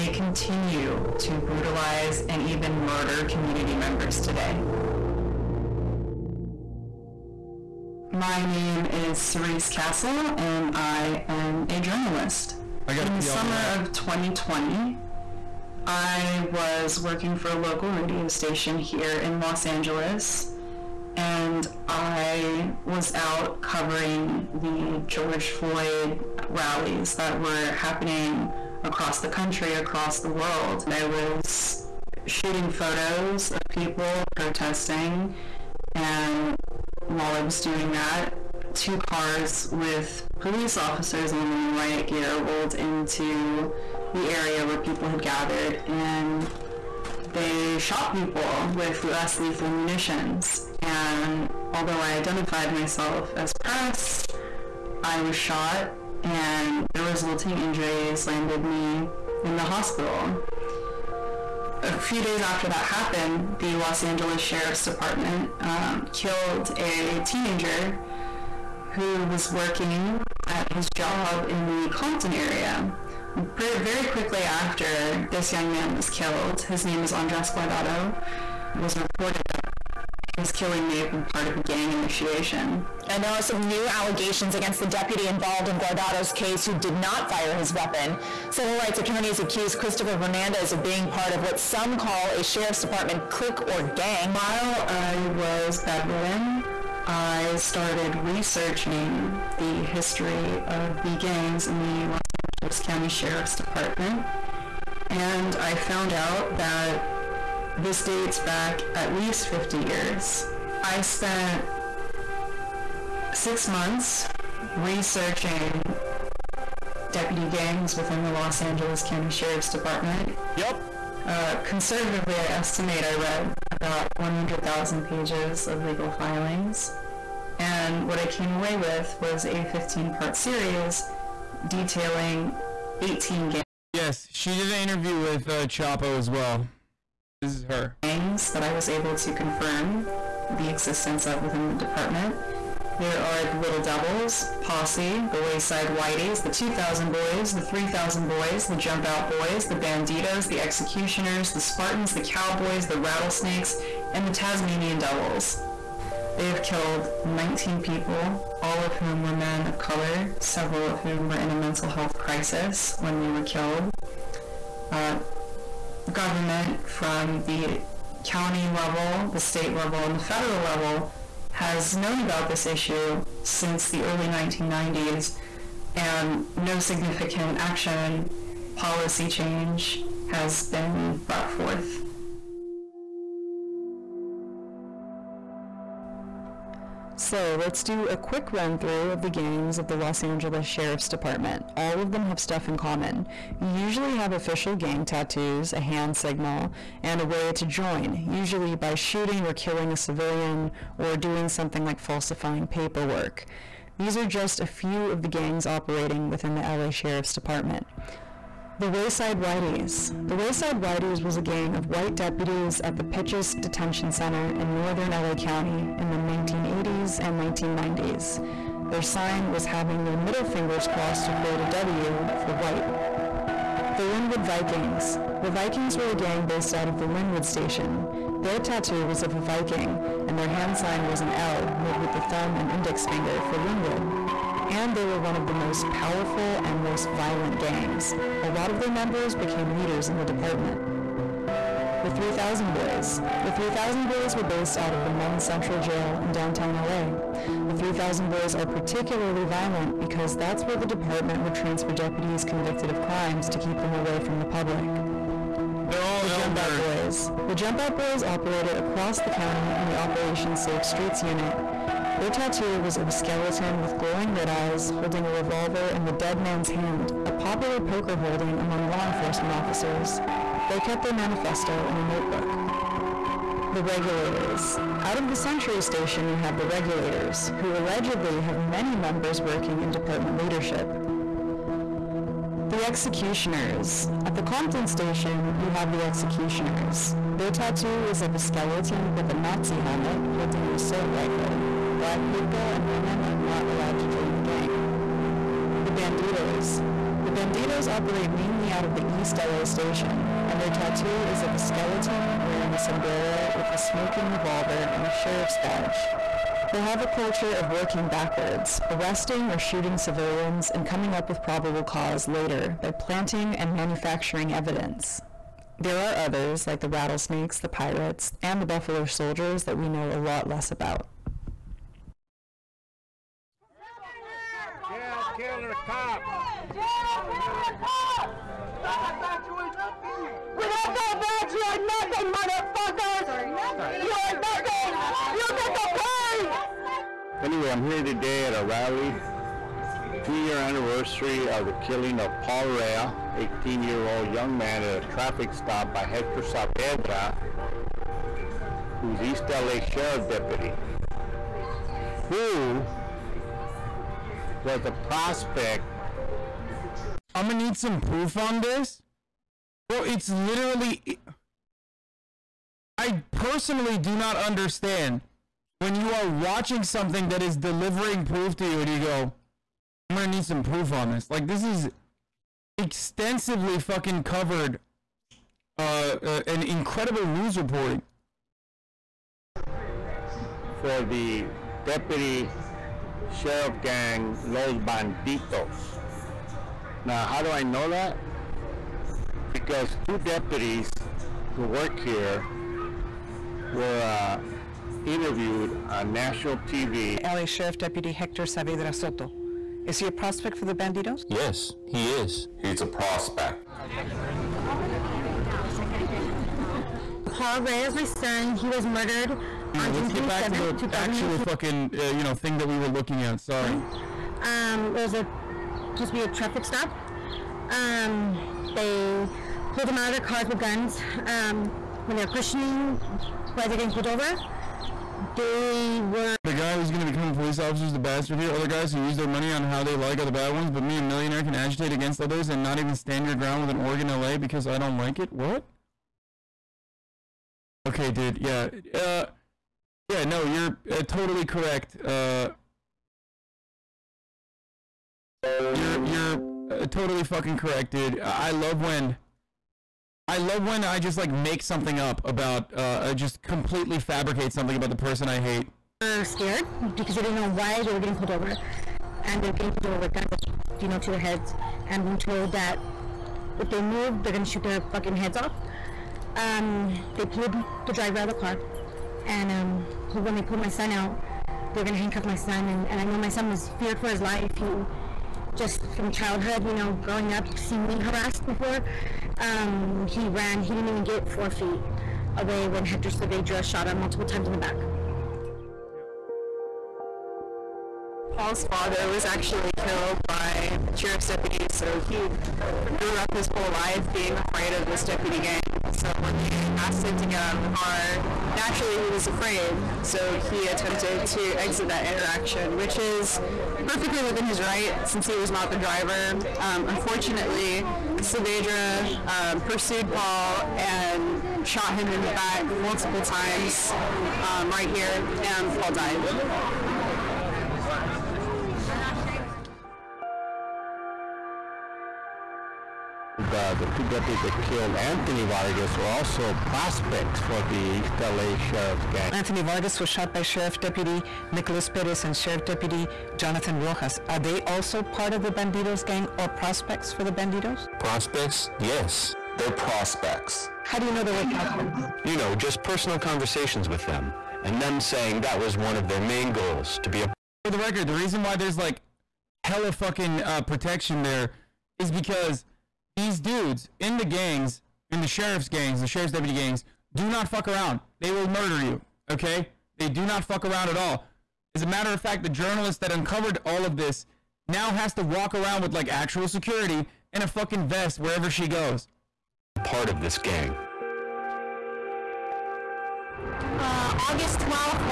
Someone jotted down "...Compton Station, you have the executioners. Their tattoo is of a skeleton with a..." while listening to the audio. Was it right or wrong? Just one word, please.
right.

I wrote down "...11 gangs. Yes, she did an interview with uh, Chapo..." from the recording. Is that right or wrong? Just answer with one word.
wrong.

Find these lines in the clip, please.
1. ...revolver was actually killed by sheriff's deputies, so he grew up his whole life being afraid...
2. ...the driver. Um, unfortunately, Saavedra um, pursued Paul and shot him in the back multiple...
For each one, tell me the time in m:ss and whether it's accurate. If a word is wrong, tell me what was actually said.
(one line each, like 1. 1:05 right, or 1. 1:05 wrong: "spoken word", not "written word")
1. 8:08 wrong: "father", not "revolver"
2. 8:25 right.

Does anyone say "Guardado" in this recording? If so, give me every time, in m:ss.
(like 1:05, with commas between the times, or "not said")
1:17, 1:25.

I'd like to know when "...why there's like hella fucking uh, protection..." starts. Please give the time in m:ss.
9:08.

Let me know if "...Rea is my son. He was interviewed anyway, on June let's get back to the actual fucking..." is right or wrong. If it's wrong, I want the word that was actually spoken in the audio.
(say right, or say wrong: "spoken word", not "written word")
wrong: "murdered", not "interviewed".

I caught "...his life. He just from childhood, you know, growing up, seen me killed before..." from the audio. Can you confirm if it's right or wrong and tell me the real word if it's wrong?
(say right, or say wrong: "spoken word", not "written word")
wrong: "harassed", not "killed".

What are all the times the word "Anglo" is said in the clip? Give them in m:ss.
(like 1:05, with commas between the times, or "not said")
not said.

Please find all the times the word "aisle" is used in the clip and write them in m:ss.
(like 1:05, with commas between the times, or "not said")
not said.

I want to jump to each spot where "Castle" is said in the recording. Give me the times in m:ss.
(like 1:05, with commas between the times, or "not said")
0:09.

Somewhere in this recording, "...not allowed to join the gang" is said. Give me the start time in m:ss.
4:53.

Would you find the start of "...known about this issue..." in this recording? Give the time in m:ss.
2:51.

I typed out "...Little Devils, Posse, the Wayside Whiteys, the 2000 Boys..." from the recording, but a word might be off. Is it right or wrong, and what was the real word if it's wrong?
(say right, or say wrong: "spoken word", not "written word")
right.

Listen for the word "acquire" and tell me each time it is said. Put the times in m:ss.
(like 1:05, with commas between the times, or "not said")
not said.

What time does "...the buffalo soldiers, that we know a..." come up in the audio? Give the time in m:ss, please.
5:18.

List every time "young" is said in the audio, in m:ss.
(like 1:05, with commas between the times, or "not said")
1:15, 5:44.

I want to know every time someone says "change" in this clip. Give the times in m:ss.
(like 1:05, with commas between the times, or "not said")
2:59.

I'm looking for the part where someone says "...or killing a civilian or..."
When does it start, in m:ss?
3:19.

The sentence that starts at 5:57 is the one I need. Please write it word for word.
I'm gonna need some proof on this.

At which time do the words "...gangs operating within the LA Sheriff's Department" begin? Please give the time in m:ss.
3:25.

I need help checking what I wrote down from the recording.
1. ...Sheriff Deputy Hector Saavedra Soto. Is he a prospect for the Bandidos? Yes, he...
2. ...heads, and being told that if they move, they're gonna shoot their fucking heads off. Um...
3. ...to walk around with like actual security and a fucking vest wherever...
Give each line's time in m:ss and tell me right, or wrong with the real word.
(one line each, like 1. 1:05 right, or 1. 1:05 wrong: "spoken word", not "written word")
1. 6:37 right
2. 7:41 right
3. 9:25 right.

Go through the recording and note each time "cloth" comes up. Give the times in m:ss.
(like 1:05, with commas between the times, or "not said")
not said.